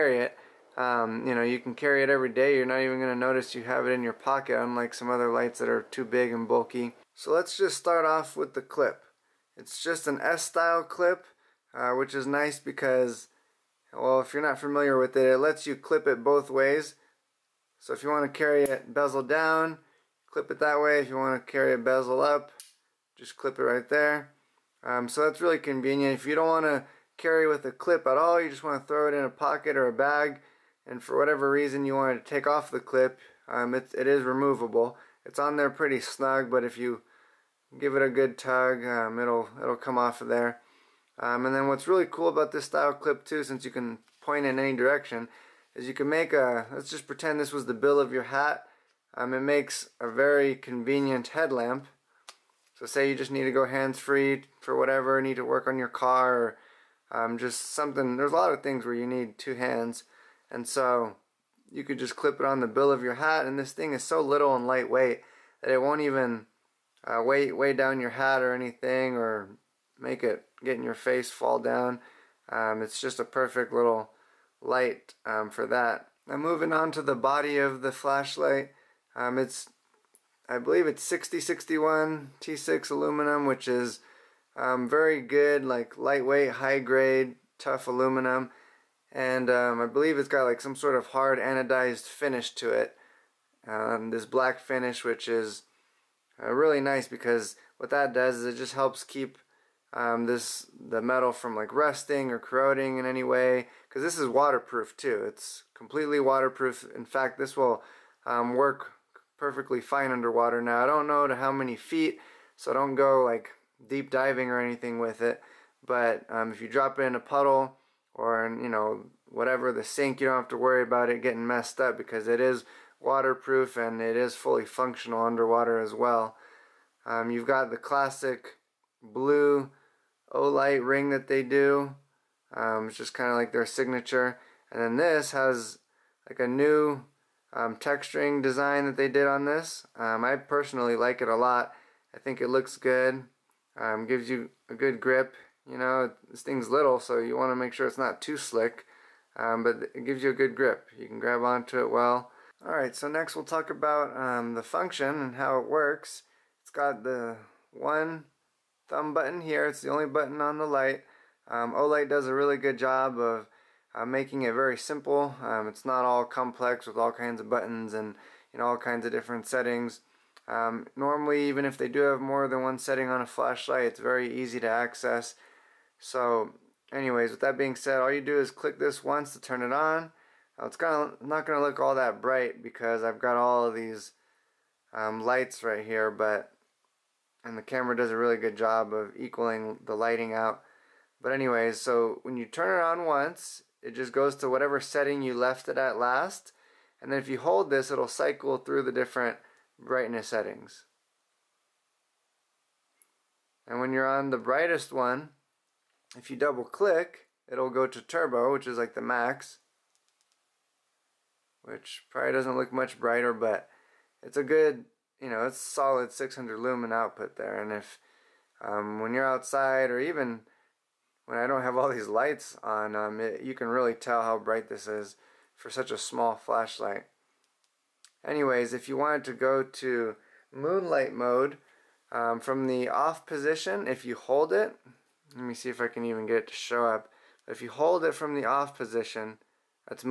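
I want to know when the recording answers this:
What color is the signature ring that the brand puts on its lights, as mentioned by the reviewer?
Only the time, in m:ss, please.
2:09.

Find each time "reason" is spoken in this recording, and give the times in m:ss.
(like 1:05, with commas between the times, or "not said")
0:31.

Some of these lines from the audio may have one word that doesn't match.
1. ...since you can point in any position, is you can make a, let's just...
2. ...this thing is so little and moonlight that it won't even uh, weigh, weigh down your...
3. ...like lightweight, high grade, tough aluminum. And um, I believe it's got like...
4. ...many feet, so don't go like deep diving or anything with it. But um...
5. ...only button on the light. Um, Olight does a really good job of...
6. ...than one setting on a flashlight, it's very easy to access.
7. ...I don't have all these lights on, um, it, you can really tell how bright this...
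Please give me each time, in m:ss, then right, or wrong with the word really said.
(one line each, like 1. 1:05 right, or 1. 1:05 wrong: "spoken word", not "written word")
1. 0:43 wrong: "direction", not "position"
2. 1:03 wrong: "lightweight", not "moonlight"
3. 1:25 right
4. 1:51 right
5. 2:39 right
6. 2:52 right
7. 3:41 right.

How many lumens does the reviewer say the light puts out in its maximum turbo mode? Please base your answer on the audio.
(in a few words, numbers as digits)
600.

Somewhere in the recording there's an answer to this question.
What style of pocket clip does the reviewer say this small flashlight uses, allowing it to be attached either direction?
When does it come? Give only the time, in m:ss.
0:10.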